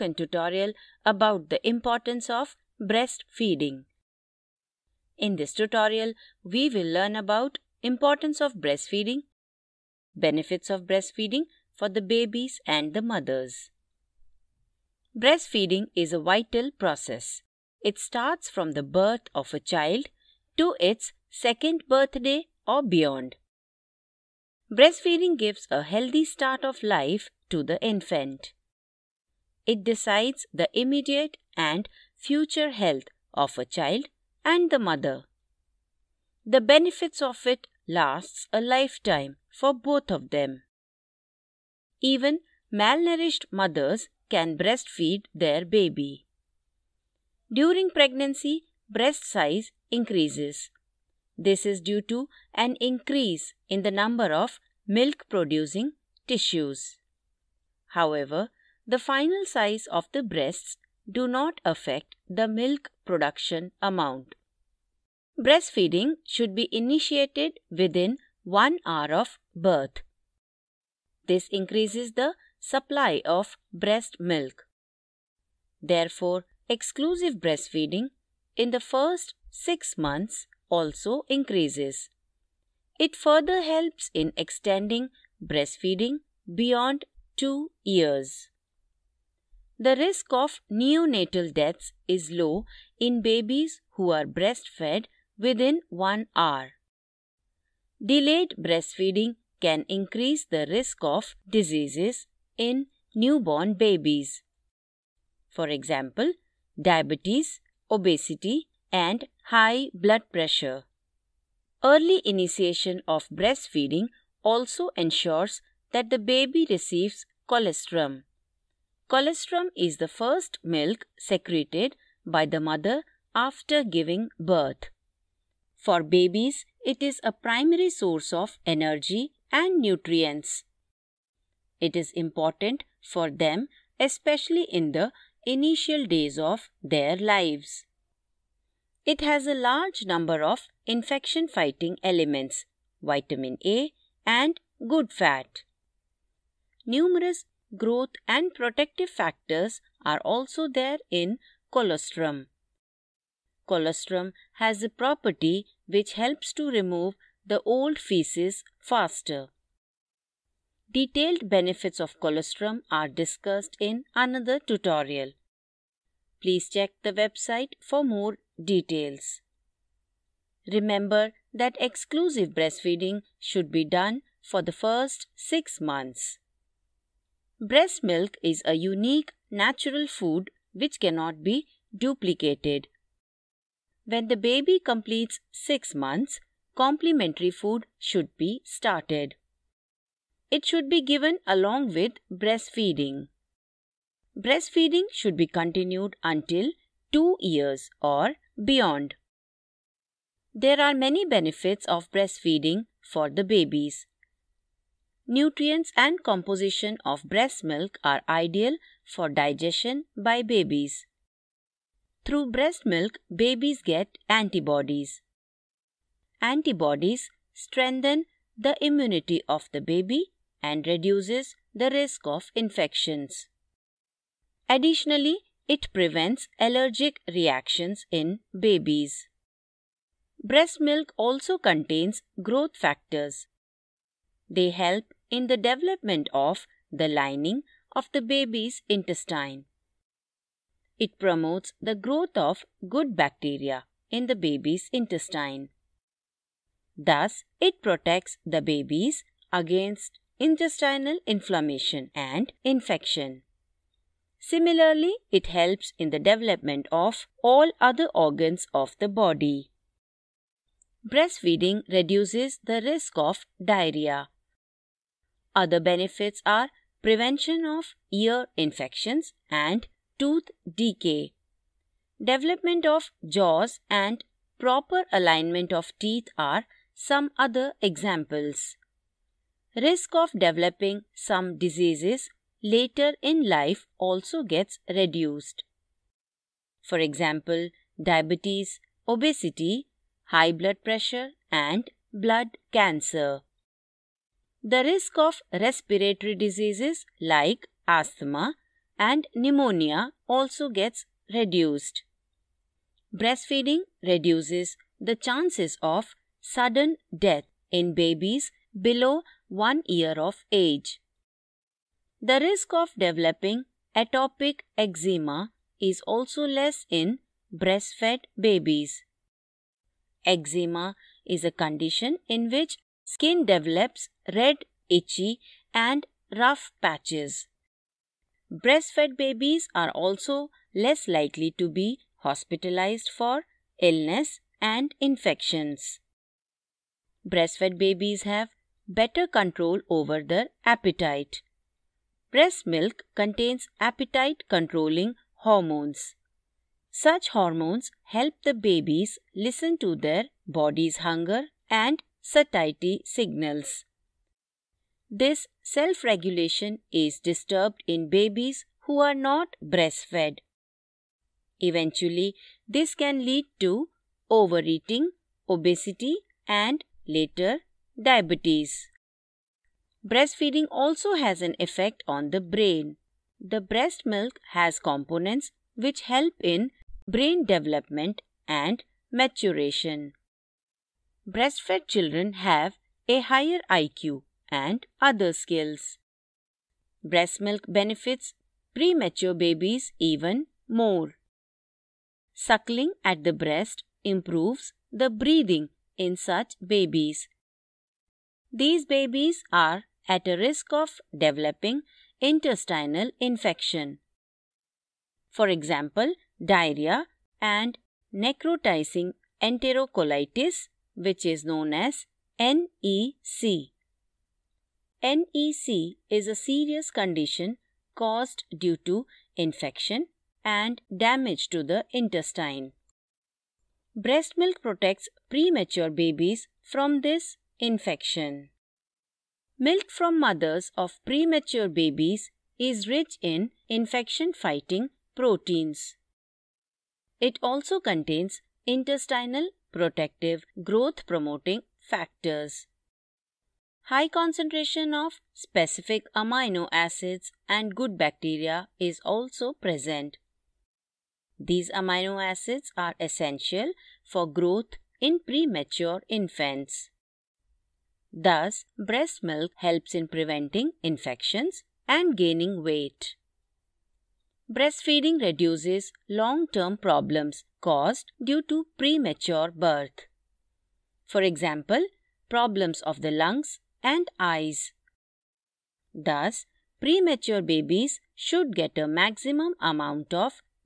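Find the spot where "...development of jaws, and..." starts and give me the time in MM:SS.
04:32.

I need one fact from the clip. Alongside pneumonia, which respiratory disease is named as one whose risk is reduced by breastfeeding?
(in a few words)
Asthma.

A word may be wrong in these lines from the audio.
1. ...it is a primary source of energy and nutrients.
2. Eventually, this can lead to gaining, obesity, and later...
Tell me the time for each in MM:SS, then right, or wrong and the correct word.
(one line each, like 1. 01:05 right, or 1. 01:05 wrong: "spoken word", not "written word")
1. 02:06 right
2. 06:01 wrong: "overeating", not "gaining".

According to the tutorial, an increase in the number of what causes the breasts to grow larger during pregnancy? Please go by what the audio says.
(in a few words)
Milk producing tissues.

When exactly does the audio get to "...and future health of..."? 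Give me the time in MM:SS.
00:31.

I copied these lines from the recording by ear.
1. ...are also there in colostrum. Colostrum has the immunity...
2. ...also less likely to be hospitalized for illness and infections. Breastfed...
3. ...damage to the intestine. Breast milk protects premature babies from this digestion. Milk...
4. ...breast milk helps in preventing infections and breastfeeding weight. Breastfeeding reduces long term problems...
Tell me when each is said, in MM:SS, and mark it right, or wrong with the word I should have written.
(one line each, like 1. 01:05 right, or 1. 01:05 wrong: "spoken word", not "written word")
1. 02:30 wrong: "property", not "immunity"
2. 05:29 right
3. 07:01 wrong: "infection", not "digestion"
4. 07:38 wrong: "gaining", not "breastfeeding".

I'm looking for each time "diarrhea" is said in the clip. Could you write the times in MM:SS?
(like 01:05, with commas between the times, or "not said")
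04:23, 06:46.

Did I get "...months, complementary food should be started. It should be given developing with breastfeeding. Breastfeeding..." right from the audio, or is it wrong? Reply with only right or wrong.
wrong.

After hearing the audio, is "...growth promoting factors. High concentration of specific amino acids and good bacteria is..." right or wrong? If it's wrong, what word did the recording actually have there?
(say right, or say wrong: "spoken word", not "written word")
right.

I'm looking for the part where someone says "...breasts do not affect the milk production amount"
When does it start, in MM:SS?
01:00.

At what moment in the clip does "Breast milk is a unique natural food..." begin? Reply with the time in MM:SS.
02:57.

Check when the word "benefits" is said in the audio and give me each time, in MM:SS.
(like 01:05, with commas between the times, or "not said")
00:10, 00:36, 02:41, 03:21, 04:25, 06:27.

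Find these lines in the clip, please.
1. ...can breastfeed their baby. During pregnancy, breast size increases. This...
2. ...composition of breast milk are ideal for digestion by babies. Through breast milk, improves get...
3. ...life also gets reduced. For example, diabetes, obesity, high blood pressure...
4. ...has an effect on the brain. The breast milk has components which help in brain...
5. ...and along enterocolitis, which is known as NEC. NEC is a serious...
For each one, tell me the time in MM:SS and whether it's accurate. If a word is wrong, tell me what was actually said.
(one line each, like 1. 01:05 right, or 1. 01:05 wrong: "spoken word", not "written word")
1. 00:44 right
2. 03:26 wrong: "babies", not "improves"
3. 04:43 right
4. 06:11 right
5. 06:47 wrong: "necrotizing", not "along".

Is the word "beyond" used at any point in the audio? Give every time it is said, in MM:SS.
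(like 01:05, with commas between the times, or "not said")
00:22, 01:26, 03:18.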